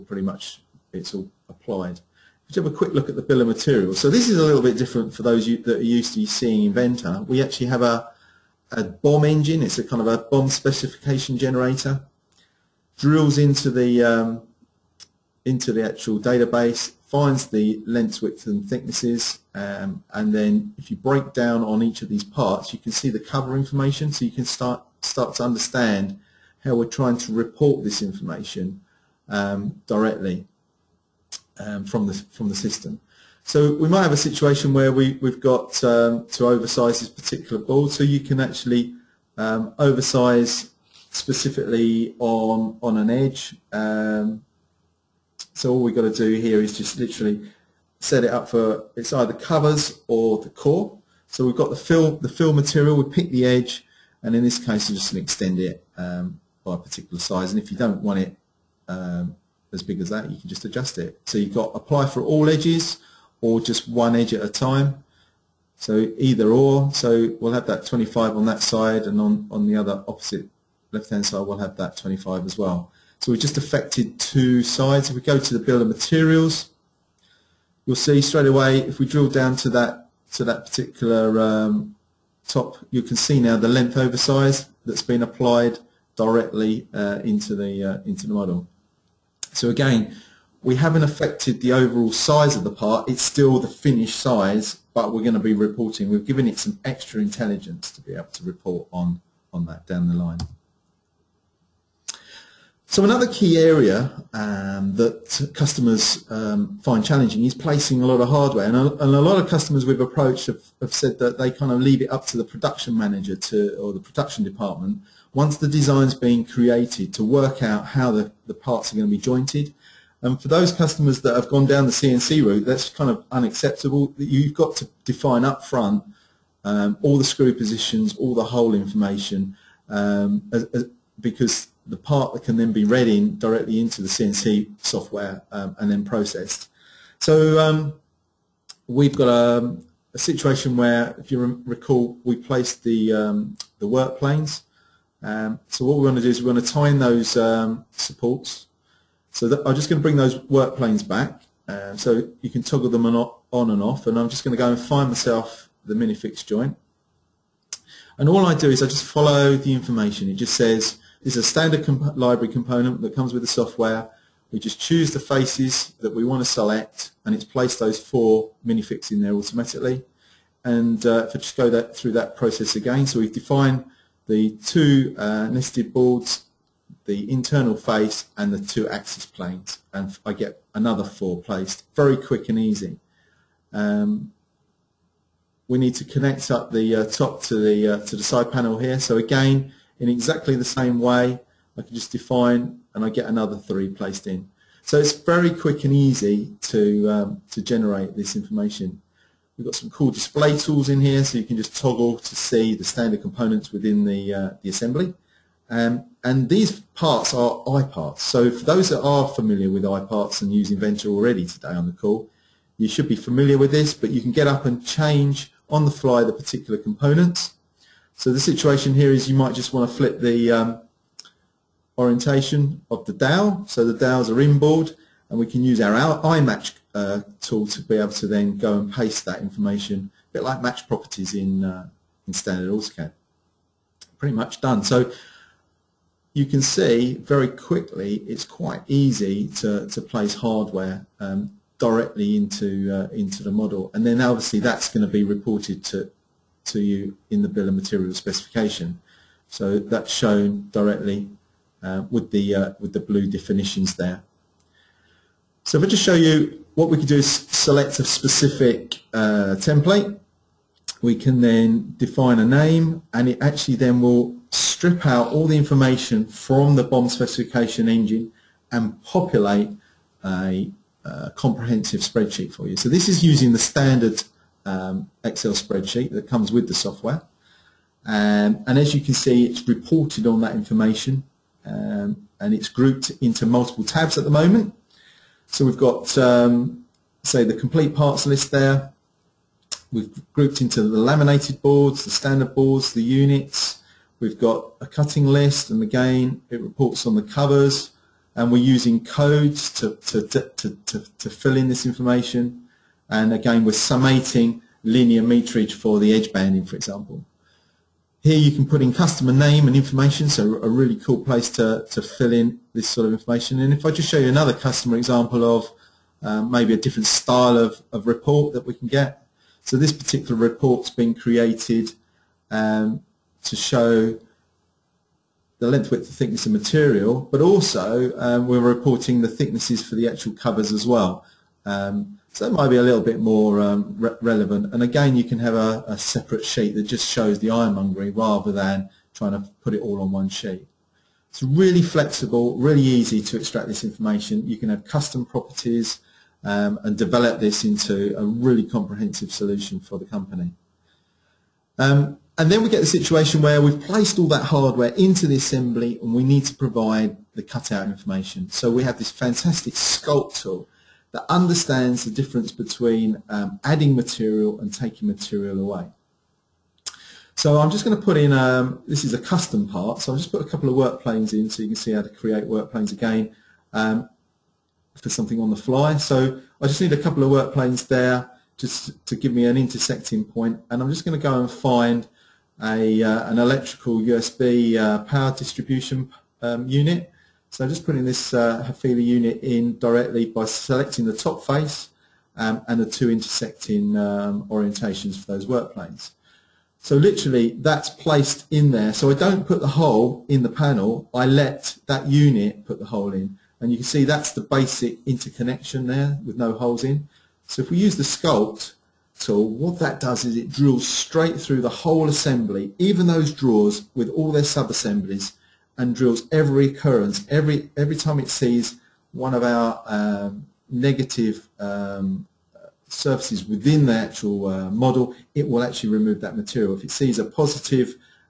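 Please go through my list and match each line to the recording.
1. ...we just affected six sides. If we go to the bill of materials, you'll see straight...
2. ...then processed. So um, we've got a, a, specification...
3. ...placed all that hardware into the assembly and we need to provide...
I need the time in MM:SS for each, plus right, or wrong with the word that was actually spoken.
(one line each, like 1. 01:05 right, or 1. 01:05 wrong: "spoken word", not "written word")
1. 01:13 wrong: "two", not "six"
2. 02:15 wrong: "situation", not "specification"
3. 05:53 right.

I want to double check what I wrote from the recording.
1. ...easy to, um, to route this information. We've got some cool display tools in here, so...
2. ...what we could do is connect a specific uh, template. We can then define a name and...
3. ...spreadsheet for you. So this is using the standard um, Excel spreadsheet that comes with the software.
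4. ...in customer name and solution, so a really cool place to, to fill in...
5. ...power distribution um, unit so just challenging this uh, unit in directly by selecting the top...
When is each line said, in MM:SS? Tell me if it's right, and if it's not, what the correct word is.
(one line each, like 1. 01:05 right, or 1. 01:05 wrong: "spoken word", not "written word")
1. 03:15 wrong: "generate", not "route"
2. 04:16 wrong: "select", not "connect"
3. 04:32 right
4. 05:08 wrong: "information", not "solution"
5. 06:25 wrong: "putting", not "challenging".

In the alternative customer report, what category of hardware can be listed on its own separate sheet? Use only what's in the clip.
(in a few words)
ironmongery.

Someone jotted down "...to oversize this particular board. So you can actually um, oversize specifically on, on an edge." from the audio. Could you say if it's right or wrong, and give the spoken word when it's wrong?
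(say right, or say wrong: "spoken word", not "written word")
right.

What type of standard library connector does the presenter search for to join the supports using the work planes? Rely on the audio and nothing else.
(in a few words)
minifix joint.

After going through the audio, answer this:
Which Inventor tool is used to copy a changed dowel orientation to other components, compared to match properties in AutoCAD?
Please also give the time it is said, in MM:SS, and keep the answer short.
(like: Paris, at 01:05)
iMatch, at 03:46.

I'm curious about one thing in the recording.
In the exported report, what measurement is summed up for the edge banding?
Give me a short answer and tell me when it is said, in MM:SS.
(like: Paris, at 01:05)
linear meterage, at 05:04.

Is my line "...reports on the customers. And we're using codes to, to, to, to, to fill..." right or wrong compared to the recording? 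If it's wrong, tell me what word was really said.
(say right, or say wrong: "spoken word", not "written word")
wrong: "covers", not "customers".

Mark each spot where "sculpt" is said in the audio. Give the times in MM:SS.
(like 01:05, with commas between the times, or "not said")
05:59, 06:48.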